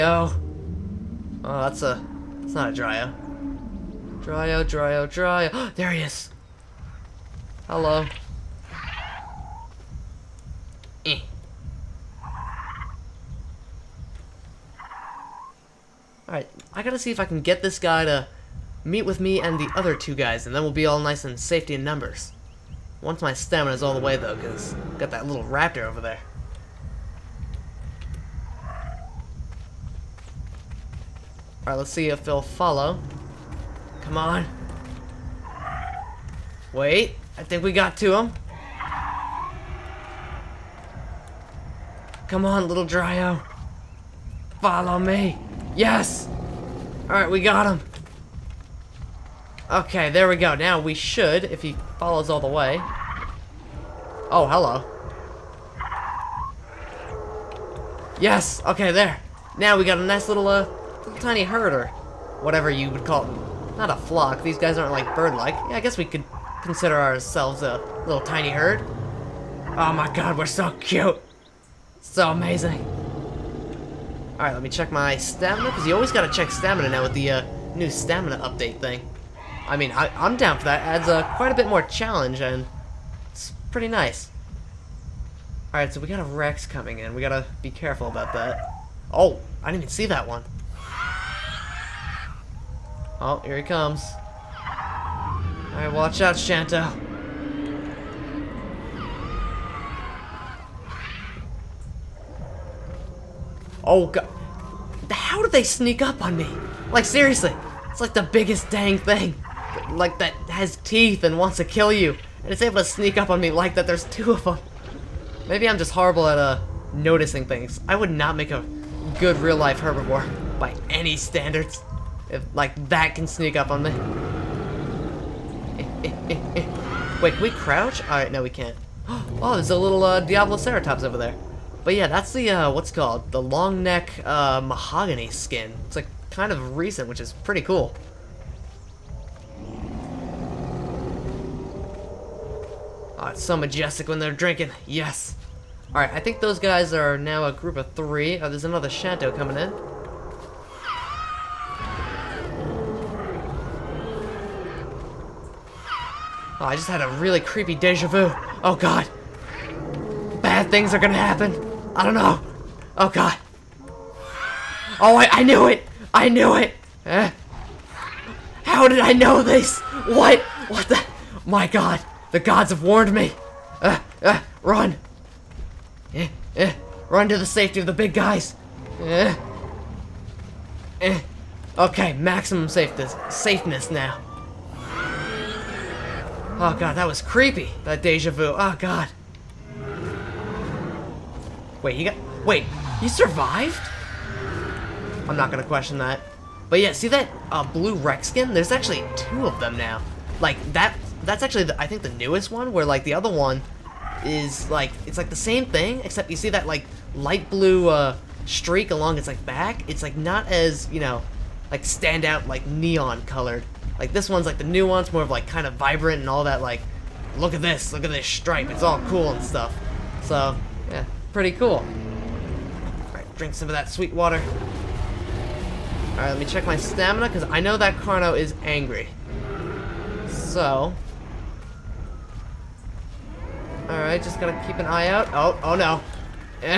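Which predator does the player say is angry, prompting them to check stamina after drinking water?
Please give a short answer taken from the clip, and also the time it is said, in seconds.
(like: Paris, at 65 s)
Carno, at 227 s.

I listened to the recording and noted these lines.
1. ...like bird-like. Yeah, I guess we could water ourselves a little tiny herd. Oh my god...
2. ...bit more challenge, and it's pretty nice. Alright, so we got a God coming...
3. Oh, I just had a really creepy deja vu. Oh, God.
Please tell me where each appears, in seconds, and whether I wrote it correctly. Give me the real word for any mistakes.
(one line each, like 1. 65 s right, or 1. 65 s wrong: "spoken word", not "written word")
1. 64 s wrong: "consider", not "water"
2. 81 s wrong: "Rex", not "God"
3. 156 s right.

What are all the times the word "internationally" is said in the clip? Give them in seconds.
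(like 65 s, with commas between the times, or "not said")
not said.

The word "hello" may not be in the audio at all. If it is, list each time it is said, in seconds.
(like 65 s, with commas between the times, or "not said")
7 s, 54 s.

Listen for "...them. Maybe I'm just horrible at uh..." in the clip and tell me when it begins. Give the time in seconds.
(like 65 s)
114 s.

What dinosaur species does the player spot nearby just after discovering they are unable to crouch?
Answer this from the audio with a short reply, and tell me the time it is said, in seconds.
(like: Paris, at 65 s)
Diabloceratops, at 130 s.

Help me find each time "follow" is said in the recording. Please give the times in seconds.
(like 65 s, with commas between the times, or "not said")
32 s, 44 s, 51 s.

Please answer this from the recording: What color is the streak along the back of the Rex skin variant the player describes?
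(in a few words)
light blue.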